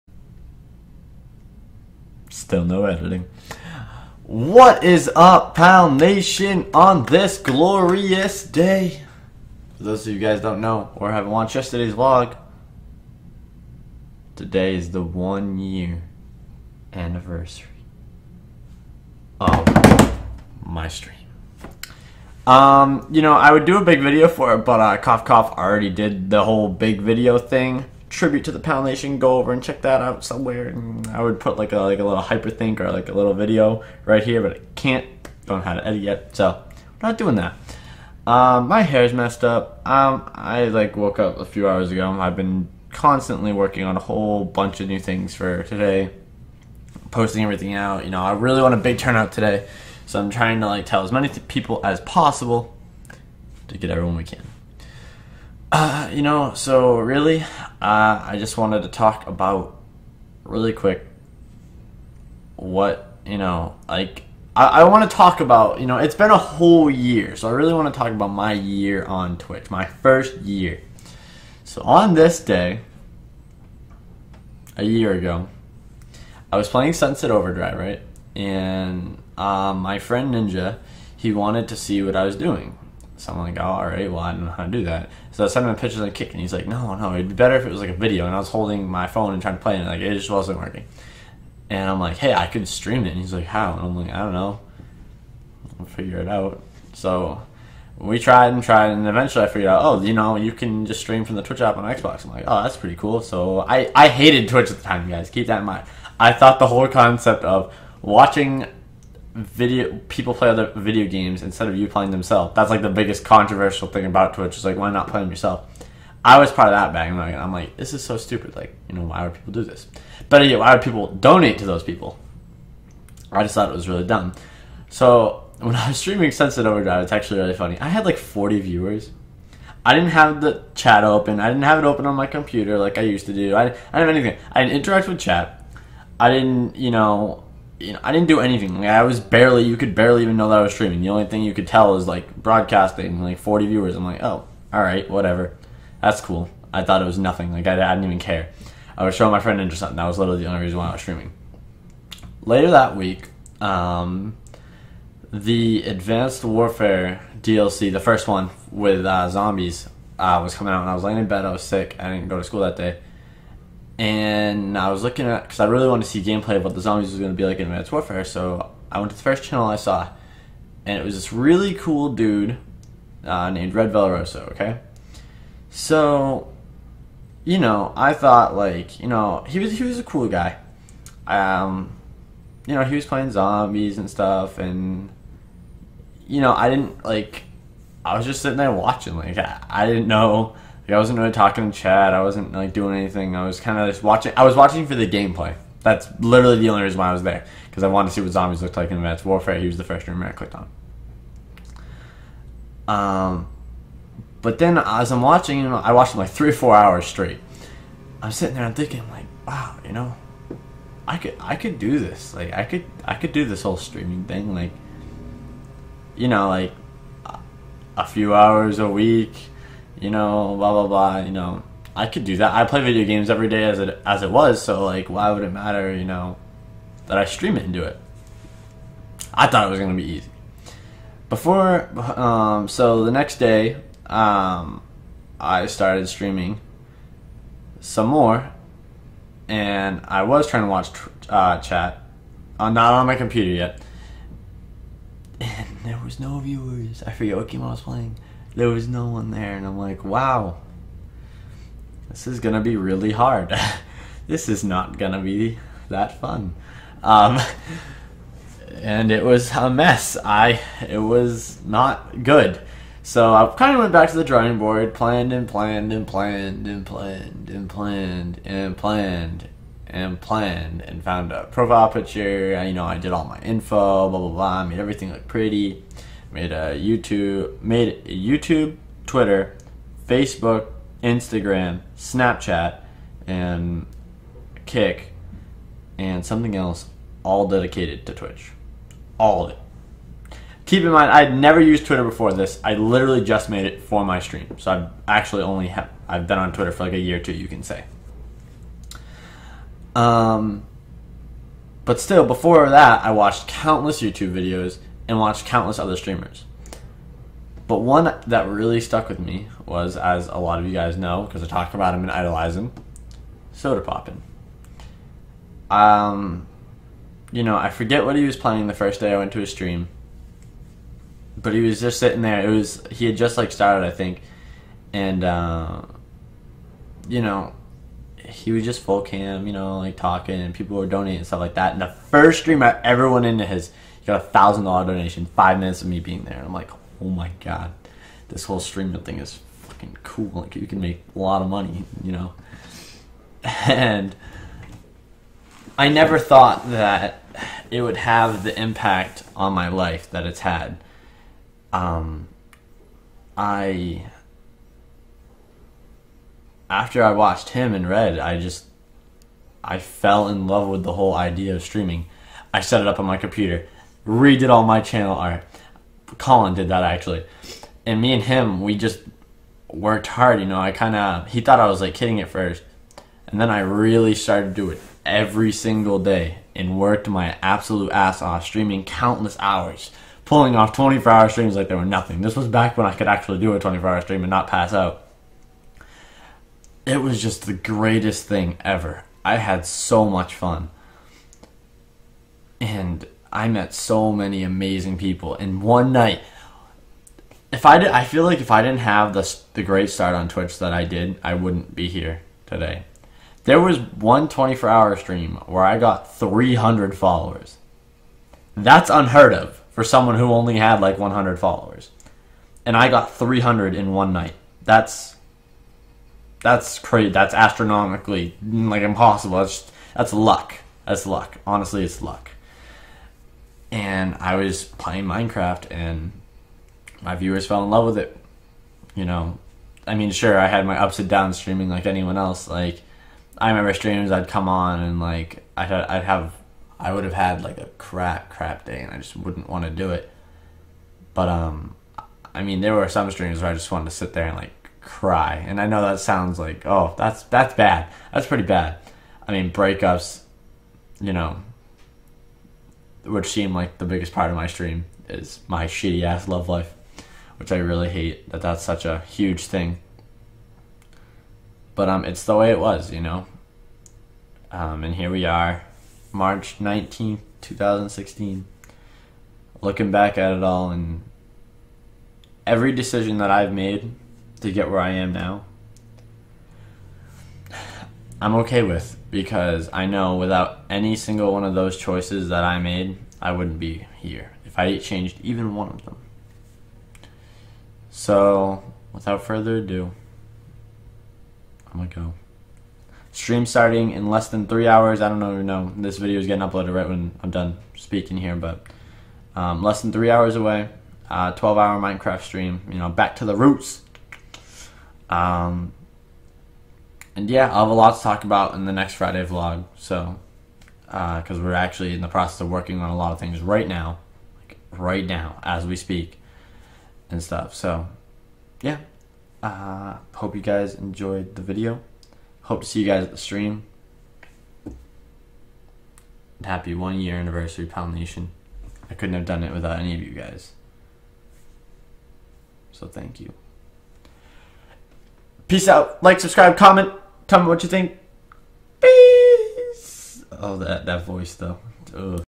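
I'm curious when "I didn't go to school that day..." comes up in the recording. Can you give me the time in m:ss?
2:41.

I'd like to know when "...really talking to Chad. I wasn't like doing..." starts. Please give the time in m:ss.
3:11.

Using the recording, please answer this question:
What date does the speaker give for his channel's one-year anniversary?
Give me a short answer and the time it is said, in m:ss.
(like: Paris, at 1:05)
March 19, 2016, at 7:46.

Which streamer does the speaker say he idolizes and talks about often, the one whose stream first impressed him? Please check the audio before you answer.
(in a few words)
Sodapoppin.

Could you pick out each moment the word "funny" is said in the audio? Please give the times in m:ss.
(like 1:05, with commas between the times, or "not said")
2:07.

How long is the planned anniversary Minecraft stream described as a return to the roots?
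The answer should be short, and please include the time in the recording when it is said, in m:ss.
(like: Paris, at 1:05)
12 hours, at 8:21.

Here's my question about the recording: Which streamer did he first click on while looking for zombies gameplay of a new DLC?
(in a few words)
Red Veloroso.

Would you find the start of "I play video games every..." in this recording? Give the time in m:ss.
3:42.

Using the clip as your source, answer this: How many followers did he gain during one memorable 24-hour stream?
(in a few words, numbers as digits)
300.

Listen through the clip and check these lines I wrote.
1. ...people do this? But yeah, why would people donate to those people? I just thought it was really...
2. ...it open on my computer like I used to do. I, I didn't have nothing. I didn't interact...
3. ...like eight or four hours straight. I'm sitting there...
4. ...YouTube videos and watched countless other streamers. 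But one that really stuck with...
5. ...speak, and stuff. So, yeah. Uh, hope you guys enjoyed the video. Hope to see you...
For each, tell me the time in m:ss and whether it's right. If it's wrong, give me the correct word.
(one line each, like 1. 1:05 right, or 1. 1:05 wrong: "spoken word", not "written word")
1. 1:59 right
2. 2:11 wrong: "anything", not "nothing"
3. 3:26 wrong: "three", not "eight"
4. 5:04 right
5. 8:35 right.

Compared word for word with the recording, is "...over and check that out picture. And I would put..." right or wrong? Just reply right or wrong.
wrong.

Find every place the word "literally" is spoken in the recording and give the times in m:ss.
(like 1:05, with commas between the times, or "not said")
2:30, 3:16, 4:52.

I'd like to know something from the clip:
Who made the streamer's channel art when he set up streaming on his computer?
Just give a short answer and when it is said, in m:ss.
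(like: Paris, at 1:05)
Colin, at 6:06.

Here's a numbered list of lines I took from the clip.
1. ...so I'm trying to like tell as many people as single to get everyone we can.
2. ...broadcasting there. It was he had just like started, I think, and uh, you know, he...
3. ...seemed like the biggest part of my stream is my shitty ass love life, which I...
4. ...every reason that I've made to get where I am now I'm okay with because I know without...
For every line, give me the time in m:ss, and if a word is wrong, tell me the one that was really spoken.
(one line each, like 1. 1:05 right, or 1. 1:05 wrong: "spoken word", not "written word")
1. 0:50 wrong: "possible", not "single"
2. 5:21 wrong: "sitting", not "broadcasting"
3. 7:33 right
4. 7:52 wrong: "decision", not "reason".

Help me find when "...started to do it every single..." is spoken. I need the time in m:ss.
6:14.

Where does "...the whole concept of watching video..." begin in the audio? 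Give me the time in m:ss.
1:46.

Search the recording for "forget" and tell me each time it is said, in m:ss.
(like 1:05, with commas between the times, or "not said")
4:07, 5:17.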